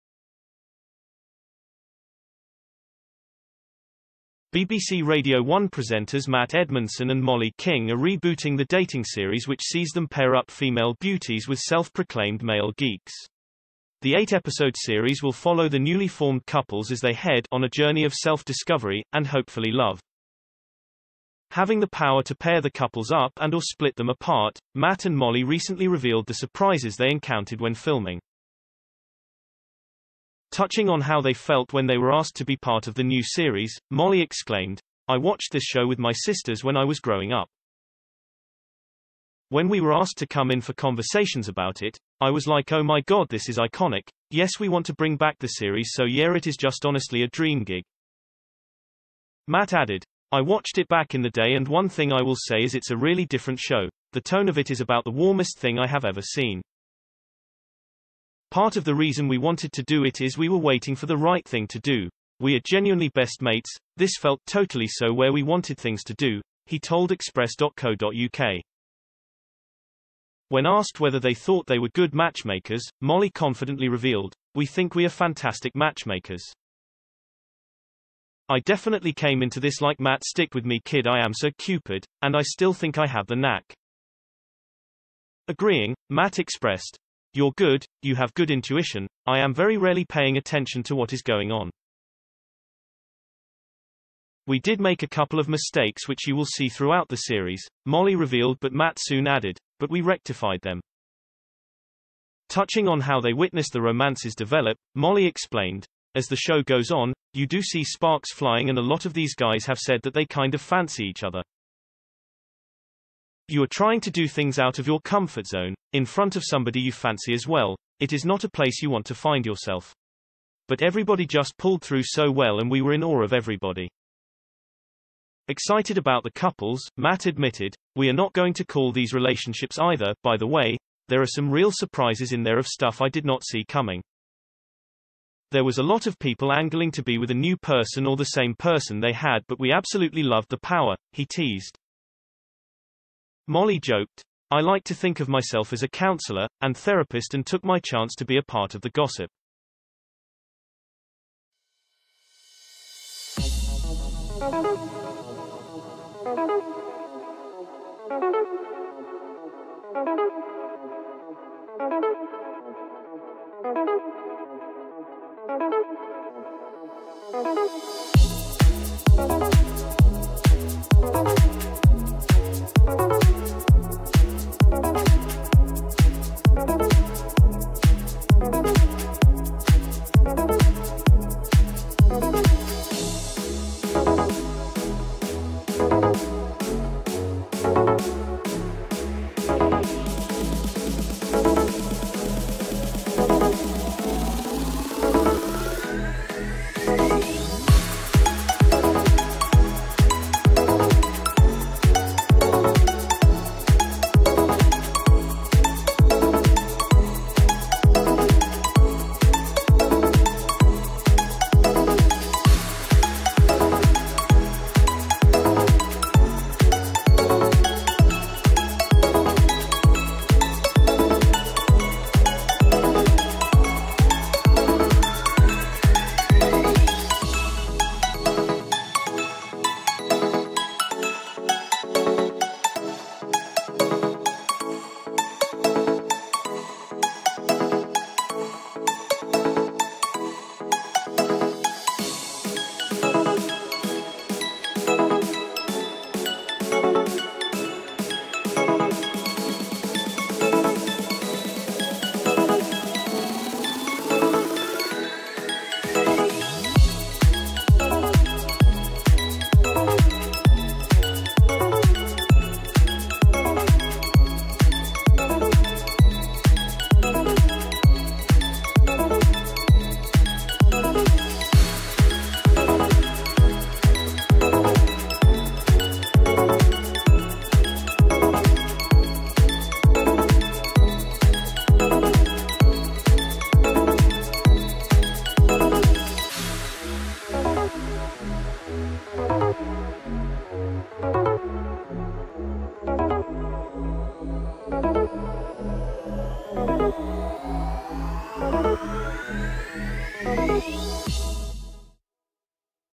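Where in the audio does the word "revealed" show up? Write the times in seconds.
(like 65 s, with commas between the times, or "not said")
25 s, 73 s, 98 s.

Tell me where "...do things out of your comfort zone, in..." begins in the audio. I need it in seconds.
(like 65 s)
114 s.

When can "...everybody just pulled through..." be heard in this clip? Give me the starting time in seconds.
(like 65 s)
120 s.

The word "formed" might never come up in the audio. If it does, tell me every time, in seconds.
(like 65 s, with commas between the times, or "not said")
16 s.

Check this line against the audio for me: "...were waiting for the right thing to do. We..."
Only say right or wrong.
right.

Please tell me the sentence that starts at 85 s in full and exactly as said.
Agreeing, Matt expressed, you're good, you have good intuition, I am very rarely paying attention to what is going on.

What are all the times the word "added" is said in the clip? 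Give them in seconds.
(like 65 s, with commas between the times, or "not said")
49 s, 99 s.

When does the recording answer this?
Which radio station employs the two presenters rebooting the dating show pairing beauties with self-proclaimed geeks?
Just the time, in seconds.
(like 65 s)
4 s.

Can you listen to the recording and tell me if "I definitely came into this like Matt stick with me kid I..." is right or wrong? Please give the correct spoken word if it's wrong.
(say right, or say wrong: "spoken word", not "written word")
right.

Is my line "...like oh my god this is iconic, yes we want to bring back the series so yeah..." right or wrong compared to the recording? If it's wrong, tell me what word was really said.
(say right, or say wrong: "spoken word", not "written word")
right.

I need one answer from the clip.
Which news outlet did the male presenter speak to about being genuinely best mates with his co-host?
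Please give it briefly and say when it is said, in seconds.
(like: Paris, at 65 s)
Express.co.uk, at 67 s.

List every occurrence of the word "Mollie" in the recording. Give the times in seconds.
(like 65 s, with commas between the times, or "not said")
7 s, 25 s, 33 s, 72 s, 97 s, 104 s, 143 s.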